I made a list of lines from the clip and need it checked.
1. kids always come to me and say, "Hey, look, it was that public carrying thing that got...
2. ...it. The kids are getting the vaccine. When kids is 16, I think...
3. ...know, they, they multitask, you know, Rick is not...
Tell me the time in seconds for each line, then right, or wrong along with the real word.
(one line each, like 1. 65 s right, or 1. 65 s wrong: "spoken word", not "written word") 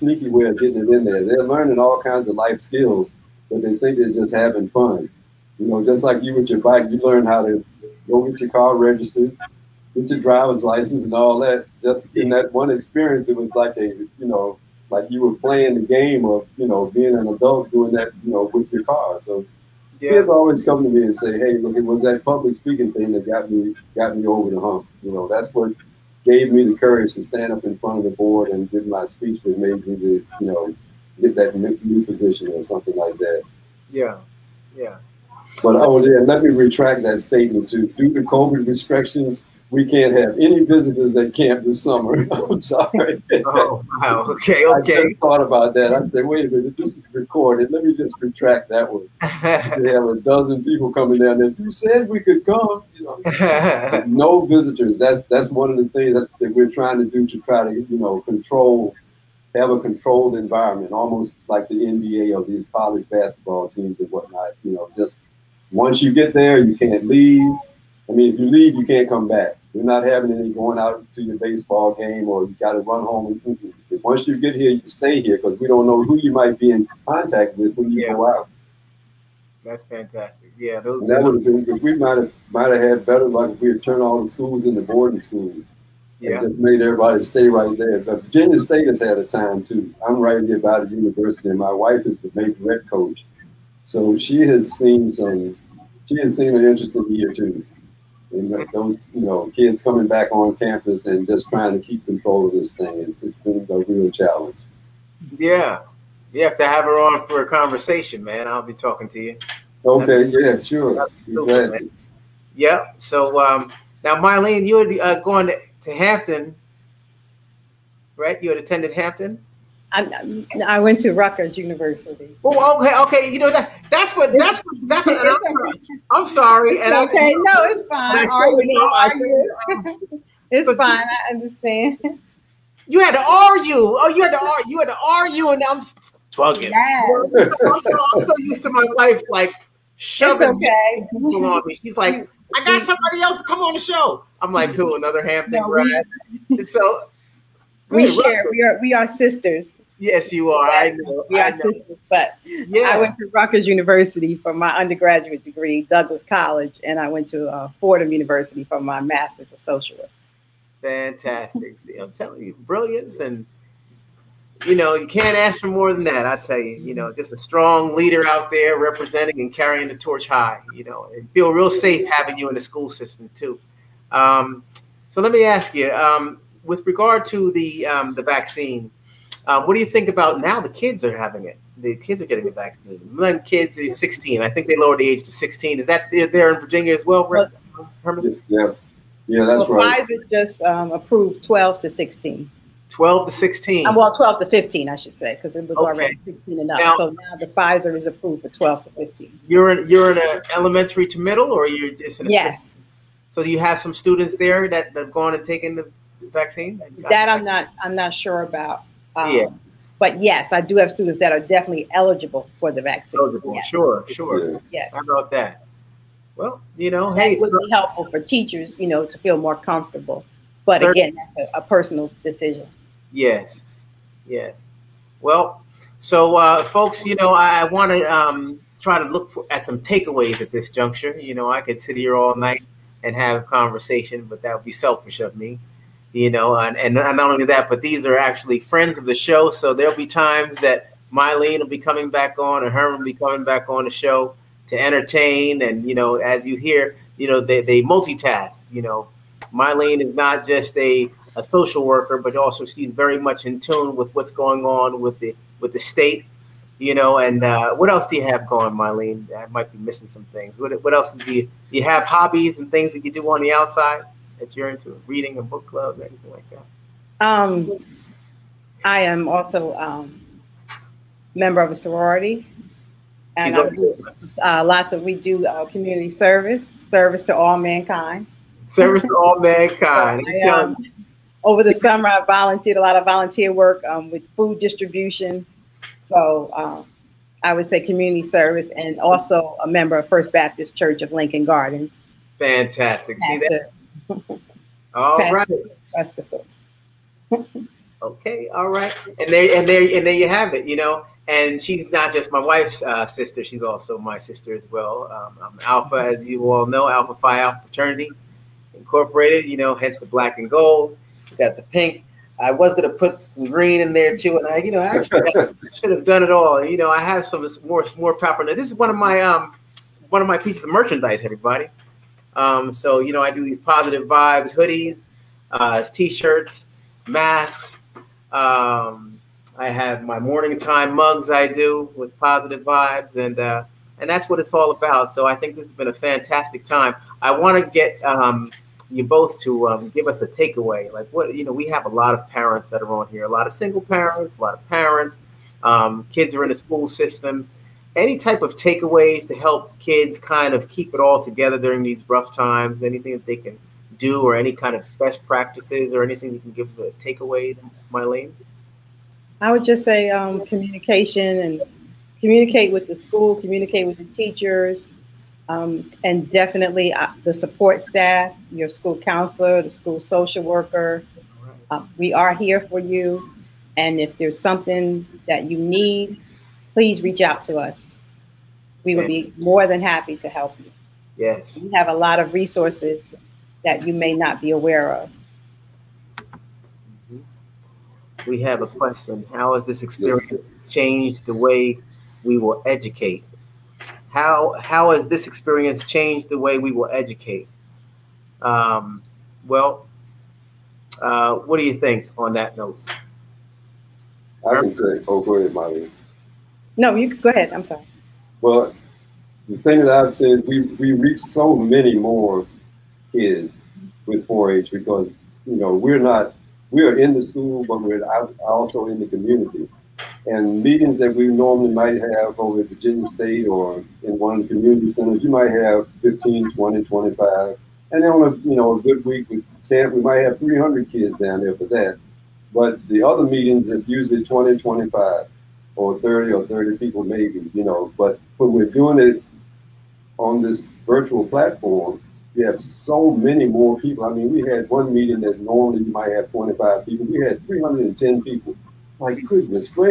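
1. 20 s wrong: "speaking", not "carrying"
2. 181 s right
3. 247 s wrong: "Mylene", not "Rick".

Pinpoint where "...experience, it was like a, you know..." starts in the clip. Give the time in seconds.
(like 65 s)
12 s.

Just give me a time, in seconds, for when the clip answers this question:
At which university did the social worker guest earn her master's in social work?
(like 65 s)
157 s.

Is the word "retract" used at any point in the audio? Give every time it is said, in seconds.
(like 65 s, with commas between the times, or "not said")
36 s, 48 s.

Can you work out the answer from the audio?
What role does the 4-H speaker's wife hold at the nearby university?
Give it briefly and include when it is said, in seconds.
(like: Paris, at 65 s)
Majorette coach, at 92 s.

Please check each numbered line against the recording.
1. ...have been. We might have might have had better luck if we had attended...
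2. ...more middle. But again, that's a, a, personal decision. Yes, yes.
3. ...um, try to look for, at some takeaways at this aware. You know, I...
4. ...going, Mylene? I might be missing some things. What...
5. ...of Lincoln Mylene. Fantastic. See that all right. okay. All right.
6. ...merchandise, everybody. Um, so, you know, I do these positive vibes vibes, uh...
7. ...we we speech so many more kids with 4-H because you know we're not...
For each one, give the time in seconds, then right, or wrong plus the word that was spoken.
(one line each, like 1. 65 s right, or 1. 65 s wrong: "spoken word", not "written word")
1. 81 s wrong: "turned", not "attended"
2. 219 s wrong: "comfortable", not "middle"
3. 228 s wrong: "juncture", not "aware"
4. 258 s right
5. 291 s wrong: "Gardens", not "Mylene"
6. 320 s wrong: "hoodies", not "vibes"
7. 410 s wrong: "reach", not "speech".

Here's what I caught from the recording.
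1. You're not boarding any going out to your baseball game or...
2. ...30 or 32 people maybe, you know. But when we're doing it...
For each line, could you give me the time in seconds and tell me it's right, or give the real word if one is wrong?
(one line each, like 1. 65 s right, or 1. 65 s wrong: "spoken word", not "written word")
1. 69 s wrong: "having", not "boarding"
2. 435 s wrong: "30", not "32".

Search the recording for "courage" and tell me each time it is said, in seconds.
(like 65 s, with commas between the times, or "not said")
26 s.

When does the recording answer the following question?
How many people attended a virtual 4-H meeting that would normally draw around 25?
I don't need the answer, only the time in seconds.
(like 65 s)
447 s.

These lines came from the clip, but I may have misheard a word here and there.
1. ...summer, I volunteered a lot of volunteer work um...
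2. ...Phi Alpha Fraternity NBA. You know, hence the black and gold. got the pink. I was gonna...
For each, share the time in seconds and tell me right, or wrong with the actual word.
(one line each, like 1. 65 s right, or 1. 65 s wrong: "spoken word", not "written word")
1. 281 s right
2. 307 s wrong: "Incorporated", not "NBA".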